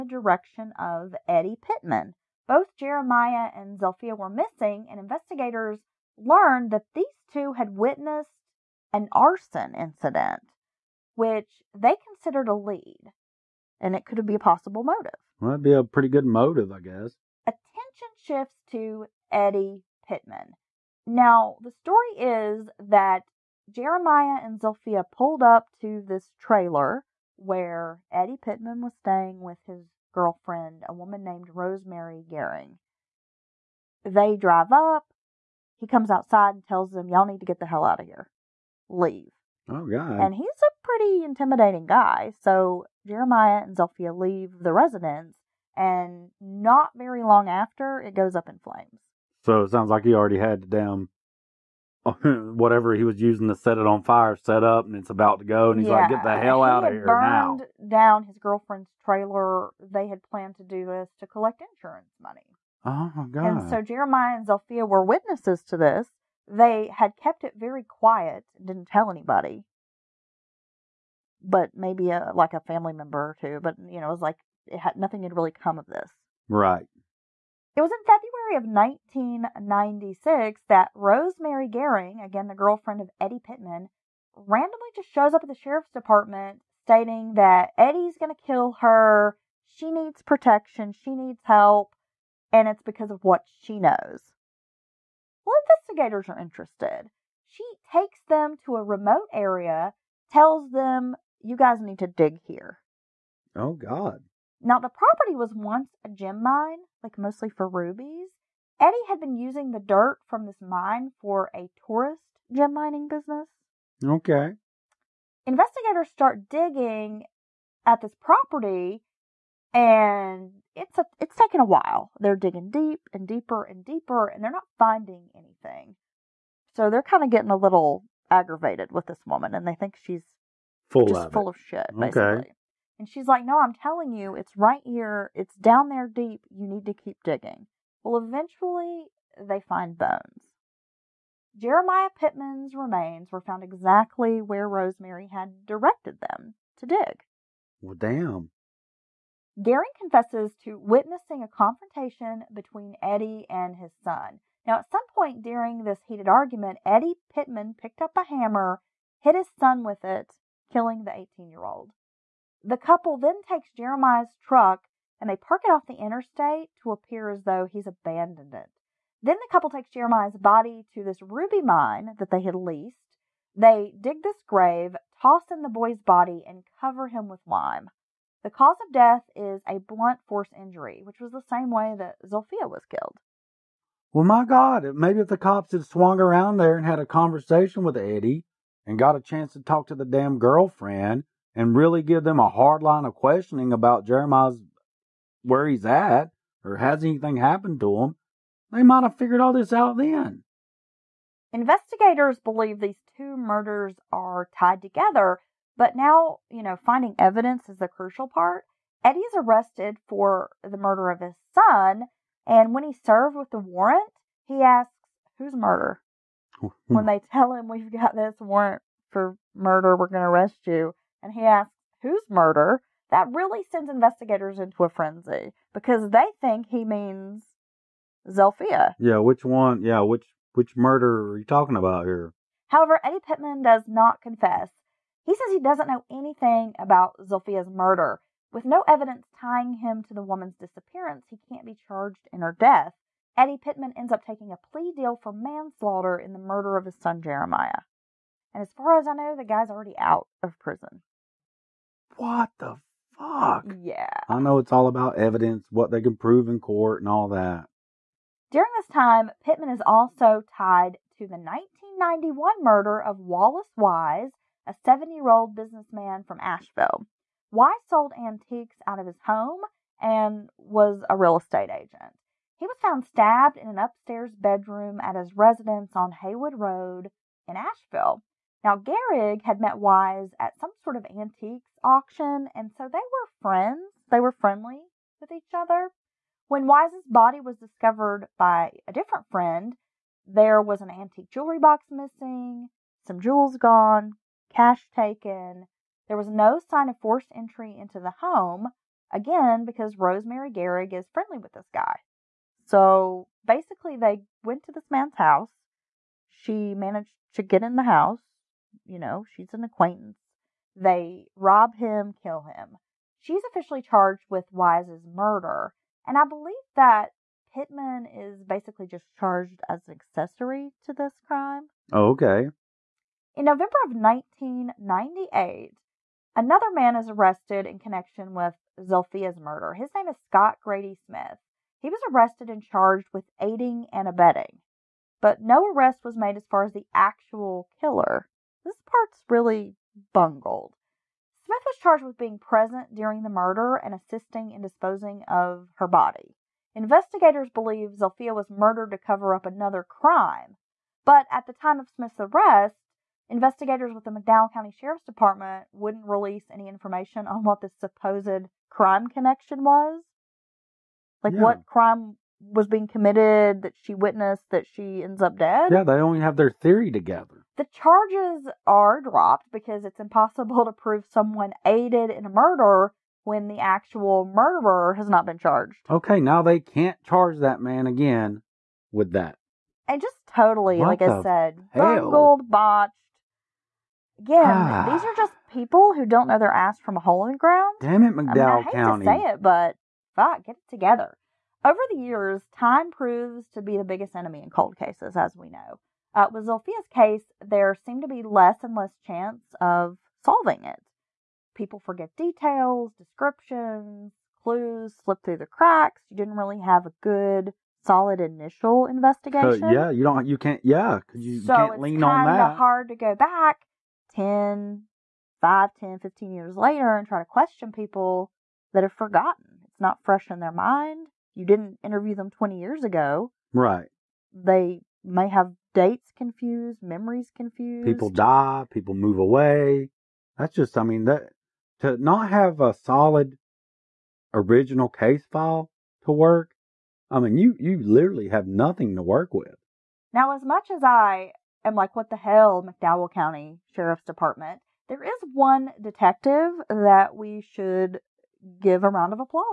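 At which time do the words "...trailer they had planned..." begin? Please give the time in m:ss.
0:59.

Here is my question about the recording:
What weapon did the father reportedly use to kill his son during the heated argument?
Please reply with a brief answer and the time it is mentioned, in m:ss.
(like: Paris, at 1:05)
A hammer, at 2:38.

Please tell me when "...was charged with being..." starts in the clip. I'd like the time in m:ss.
5:41.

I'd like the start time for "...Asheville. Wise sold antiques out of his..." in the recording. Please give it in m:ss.
4:26.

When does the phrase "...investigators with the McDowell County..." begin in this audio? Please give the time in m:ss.
5:53.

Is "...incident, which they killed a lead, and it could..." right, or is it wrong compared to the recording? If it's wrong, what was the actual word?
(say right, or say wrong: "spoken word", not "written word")
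wrong: "considered", not "killed".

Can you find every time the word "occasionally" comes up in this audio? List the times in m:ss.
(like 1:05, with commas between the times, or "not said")
not said.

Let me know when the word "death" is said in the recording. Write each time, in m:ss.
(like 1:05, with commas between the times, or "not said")
2:58, 4:02.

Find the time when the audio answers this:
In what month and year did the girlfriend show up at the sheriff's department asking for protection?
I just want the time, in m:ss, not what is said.
1:18.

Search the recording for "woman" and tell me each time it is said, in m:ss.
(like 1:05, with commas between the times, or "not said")
0:30, 2:09, 4:00.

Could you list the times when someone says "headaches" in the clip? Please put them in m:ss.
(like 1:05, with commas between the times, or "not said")
not said.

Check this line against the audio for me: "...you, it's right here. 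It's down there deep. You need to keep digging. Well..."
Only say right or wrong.
right.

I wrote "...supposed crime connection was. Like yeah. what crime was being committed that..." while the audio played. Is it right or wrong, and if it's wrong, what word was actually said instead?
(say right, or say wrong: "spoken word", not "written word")
right.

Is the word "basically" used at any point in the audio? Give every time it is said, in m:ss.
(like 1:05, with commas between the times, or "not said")
2:11, 5:03, 5:18.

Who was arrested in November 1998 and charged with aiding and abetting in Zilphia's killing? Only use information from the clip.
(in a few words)
Scott Grady Smith.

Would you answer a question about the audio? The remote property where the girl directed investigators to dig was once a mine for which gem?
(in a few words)
Rubies.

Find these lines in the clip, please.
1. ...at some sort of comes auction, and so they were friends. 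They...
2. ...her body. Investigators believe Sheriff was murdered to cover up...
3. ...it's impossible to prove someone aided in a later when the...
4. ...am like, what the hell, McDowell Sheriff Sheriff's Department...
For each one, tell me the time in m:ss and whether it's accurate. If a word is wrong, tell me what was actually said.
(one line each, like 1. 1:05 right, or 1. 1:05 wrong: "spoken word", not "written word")
1. 4:40 wrong: "antiques", not "comes"
2. 5:45 wrong: "Zilphia", not "Sheriff"
3. 6:09 wrong: "murder", not "later"
4. 7:21 wrong: "County", not "Sheriff".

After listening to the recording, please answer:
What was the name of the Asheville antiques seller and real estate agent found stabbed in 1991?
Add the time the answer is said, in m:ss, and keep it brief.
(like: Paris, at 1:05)
Wallace Wise, at 4:23.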